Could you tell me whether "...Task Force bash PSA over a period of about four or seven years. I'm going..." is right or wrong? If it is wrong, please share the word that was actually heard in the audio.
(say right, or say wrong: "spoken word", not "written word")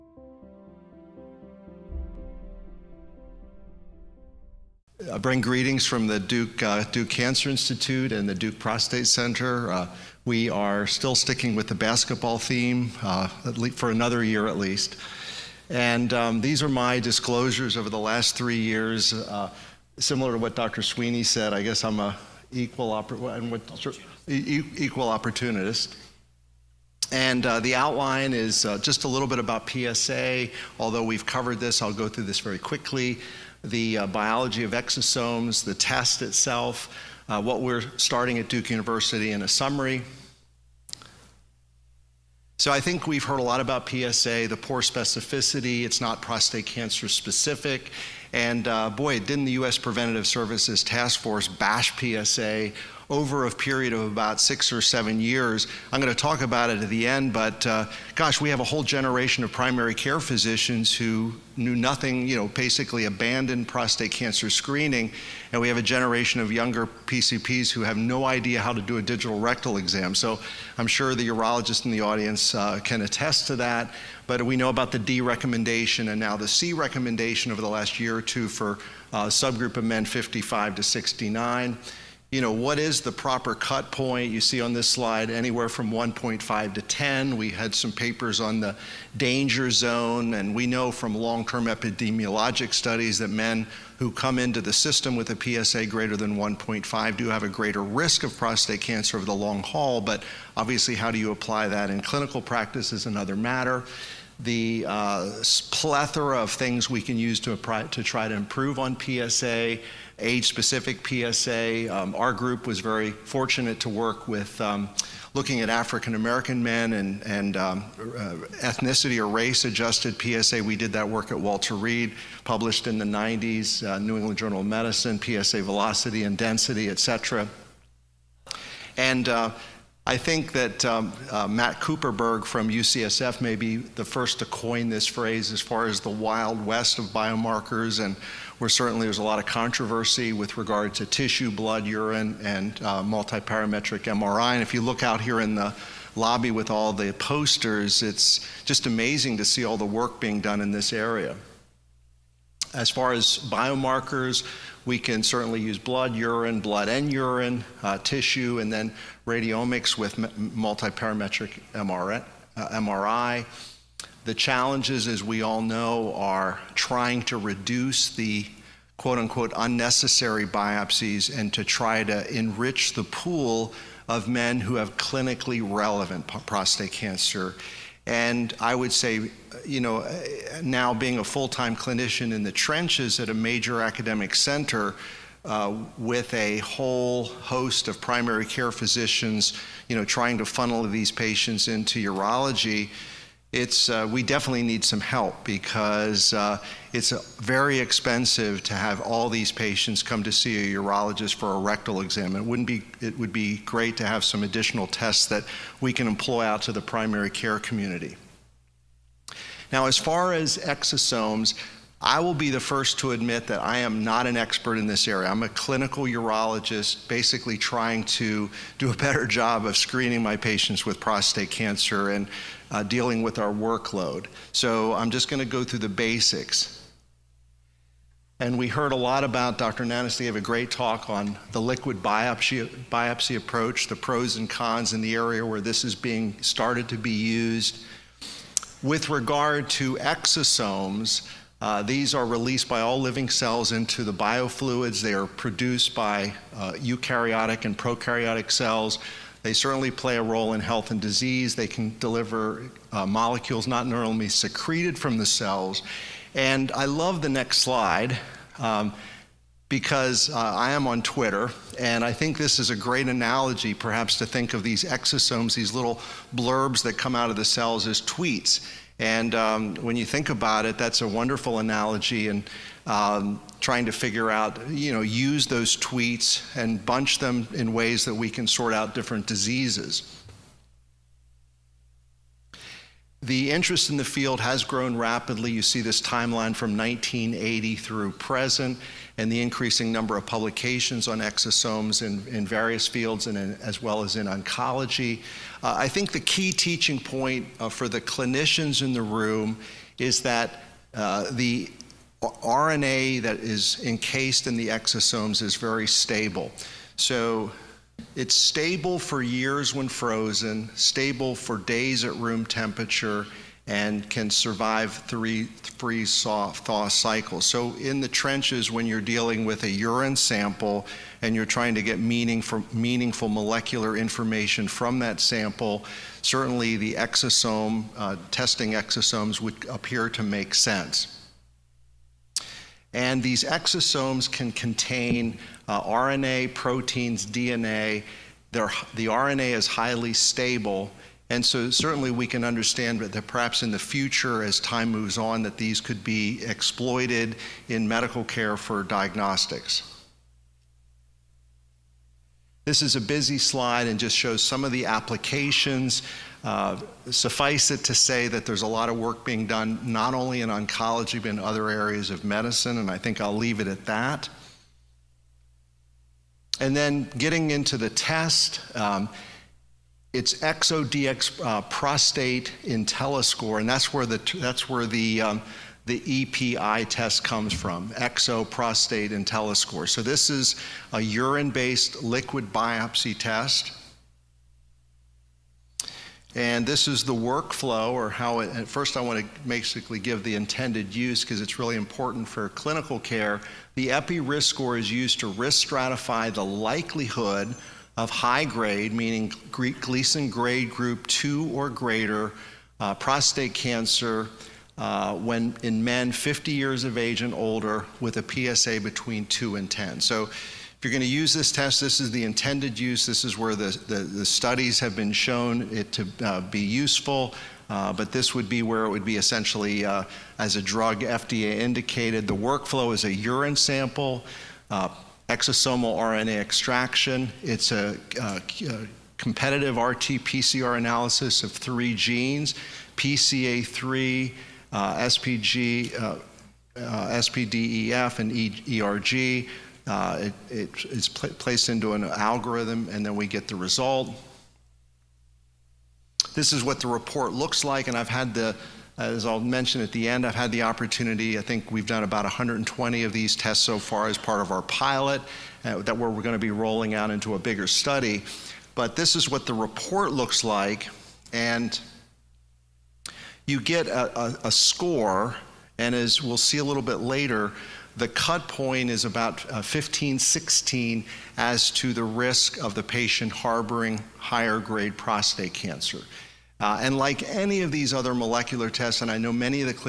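wrong: "six", not "four".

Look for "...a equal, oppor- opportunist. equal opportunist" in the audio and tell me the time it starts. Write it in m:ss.
0:21.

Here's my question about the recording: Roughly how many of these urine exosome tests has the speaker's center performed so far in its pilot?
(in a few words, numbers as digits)
120.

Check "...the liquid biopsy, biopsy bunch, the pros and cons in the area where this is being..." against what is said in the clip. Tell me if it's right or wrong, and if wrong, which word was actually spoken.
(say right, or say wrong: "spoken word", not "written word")
wrong: "approach", not "bunch".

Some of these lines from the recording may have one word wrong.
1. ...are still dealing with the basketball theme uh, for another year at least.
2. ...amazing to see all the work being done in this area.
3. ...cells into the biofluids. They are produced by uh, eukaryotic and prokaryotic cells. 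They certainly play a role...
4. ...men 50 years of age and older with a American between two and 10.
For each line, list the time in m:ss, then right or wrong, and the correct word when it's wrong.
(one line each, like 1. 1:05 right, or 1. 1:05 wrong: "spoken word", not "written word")
1. 0:10 wrong: "sticking", not "dealing"
2. 2:28 right
3. 4:03 right
4. 6:45 wrong: "PSA", not "American".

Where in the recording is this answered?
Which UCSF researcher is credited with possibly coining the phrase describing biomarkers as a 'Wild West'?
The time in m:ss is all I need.
2:11.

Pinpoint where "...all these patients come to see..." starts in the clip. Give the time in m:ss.
3:19.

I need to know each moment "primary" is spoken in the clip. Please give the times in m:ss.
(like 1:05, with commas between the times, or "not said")
0:59, 3:08, 3:26.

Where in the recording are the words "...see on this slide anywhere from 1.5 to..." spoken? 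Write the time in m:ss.
1:24.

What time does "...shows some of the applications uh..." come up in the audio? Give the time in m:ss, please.
5:54.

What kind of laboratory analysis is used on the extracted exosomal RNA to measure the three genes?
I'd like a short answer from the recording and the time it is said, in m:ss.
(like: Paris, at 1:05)
Competitive RT-PCR, at 7:09.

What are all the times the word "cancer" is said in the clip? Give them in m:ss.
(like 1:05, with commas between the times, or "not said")
0:07, 0:46, 1:04, 1:38, 2:56, 3:41, 6:43, 7:55.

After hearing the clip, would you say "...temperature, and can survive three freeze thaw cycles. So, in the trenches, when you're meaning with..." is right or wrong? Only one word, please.
wrong.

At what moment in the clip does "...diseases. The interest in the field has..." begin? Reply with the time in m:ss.
4:39.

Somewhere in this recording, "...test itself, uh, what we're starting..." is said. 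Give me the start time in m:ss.
0:35.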